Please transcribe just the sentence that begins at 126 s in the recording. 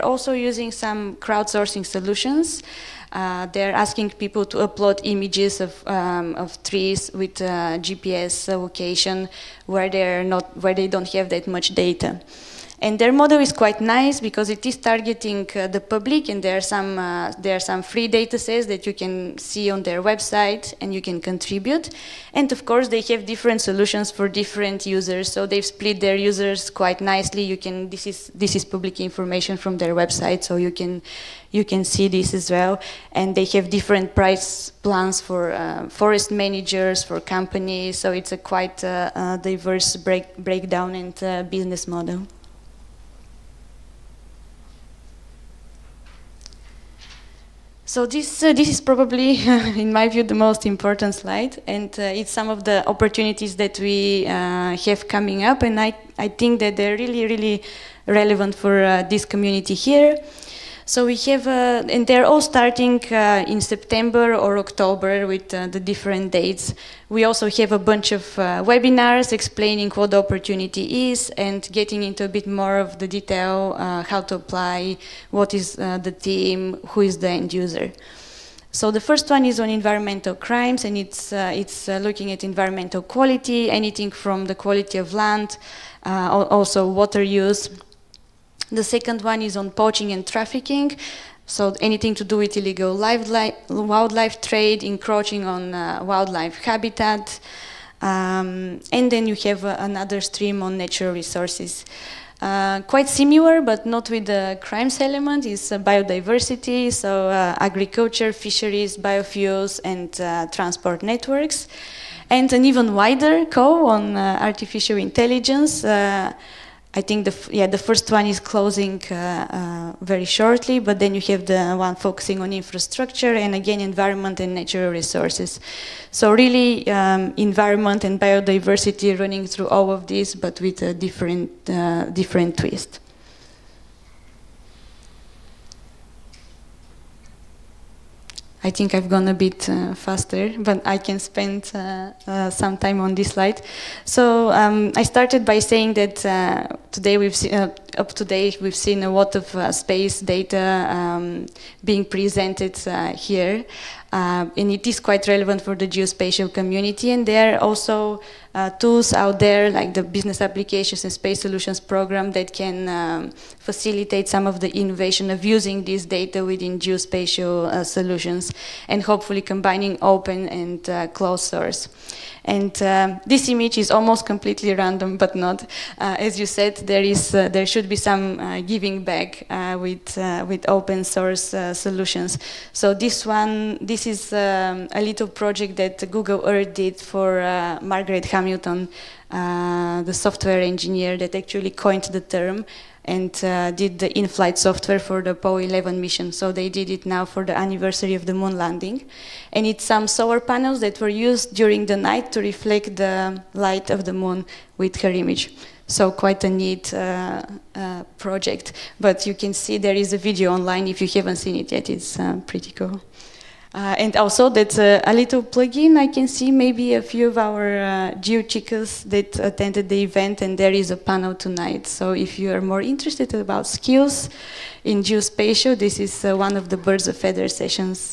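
So really, um, environment and biodiversity running through all of this, but with a different uh, different twist.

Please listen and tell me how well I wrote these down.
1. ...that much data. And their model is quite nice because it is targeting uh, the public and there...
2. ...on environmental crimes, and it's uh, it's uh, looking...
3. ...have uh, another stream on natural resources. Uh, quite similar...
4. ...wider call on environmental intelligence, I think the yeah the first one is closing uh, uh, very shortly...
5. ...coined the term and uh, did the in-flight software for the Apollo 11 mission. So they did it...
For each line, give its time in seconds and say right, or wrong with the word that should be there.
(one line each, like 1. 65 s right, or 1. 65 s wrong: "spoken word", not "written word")
1. 11 s right
2. 79 s right
3. 99 s right
4. 112 s wrong: "artificial", not "environmental"
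5. 191 s right.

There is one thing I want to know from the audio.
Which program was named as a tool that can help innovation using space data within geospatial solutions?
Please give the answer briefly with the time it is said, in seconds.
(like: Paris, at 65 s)
Business Applications and Space Solutions, at 160 s.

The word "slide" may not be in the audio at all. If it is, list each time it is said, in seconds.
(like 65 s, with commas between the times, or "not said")
51 s, 143 s.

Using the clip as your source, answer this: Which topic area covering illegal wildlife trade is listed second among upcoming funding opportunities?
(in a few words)
poaching and trafficking.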